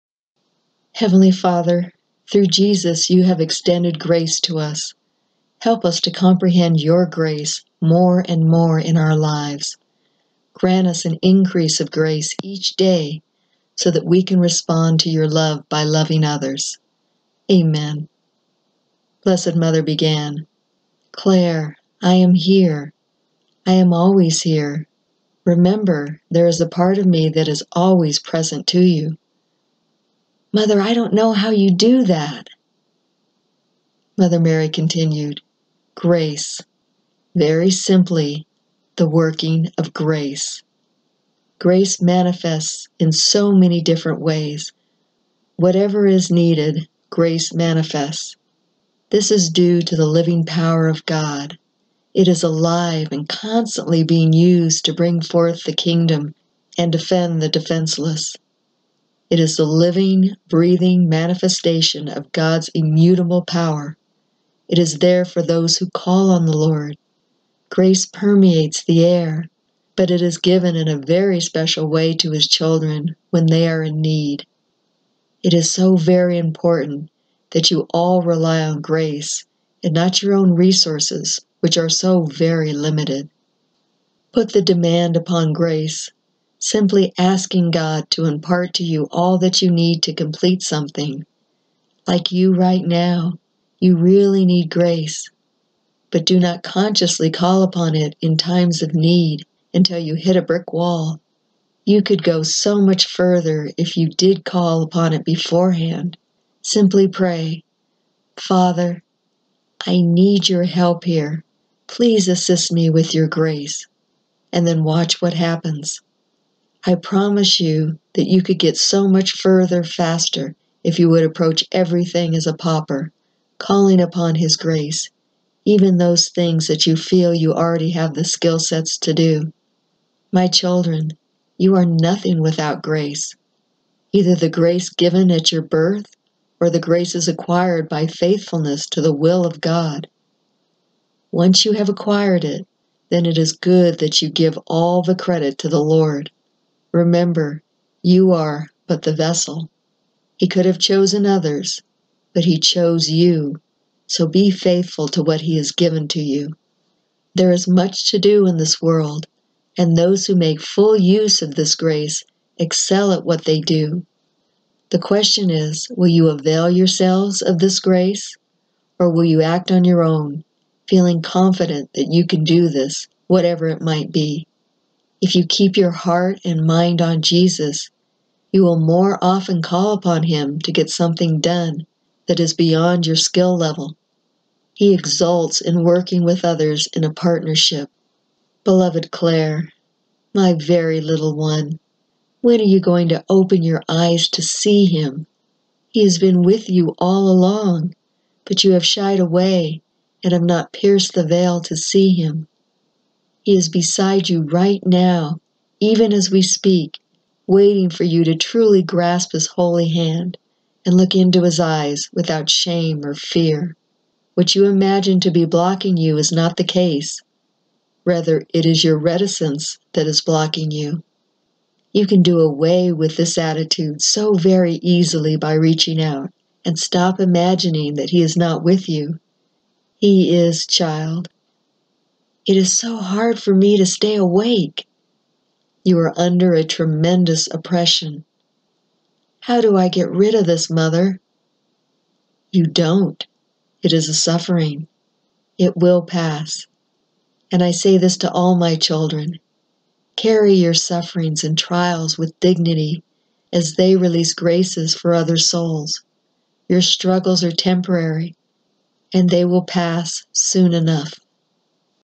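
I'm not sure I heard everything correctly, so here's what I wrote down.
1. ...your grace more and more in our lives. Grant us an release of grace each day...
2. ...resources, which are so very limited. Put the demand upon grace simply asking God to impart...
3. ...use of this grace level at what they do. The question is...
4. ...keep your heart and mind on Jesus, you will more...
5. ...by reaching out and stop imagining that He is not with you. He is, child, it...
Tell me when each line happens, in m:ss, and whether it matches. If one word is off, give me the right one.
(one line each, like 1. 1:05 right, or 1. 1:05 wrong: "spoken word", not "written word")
1. 0:06 wrong: "increase", not "release"
2. 1:20 right
3. 2:40 wrong: "excel", not "level"
4. 2:55 right
5. 3:45 right.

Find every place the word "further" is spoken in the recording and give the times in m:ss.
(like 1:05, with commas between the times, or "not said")
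1:43, 1:59.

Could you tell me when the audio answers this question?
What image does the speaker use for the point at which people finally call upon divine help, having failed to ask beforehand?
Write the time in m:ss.
1:40.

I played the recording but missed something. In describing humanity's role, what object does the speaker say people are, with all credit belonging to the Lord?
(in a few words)
the vessel.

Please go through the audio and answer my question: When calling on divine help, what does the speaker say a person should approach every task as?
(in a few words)
a pauper.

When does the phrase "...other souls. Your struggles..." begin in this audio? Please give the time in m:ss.
4:15.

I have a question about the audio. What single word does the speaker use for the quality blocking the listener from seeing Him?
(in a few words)
reticence.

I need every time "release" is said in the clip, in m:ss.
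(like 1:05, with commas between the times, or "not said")
4:13.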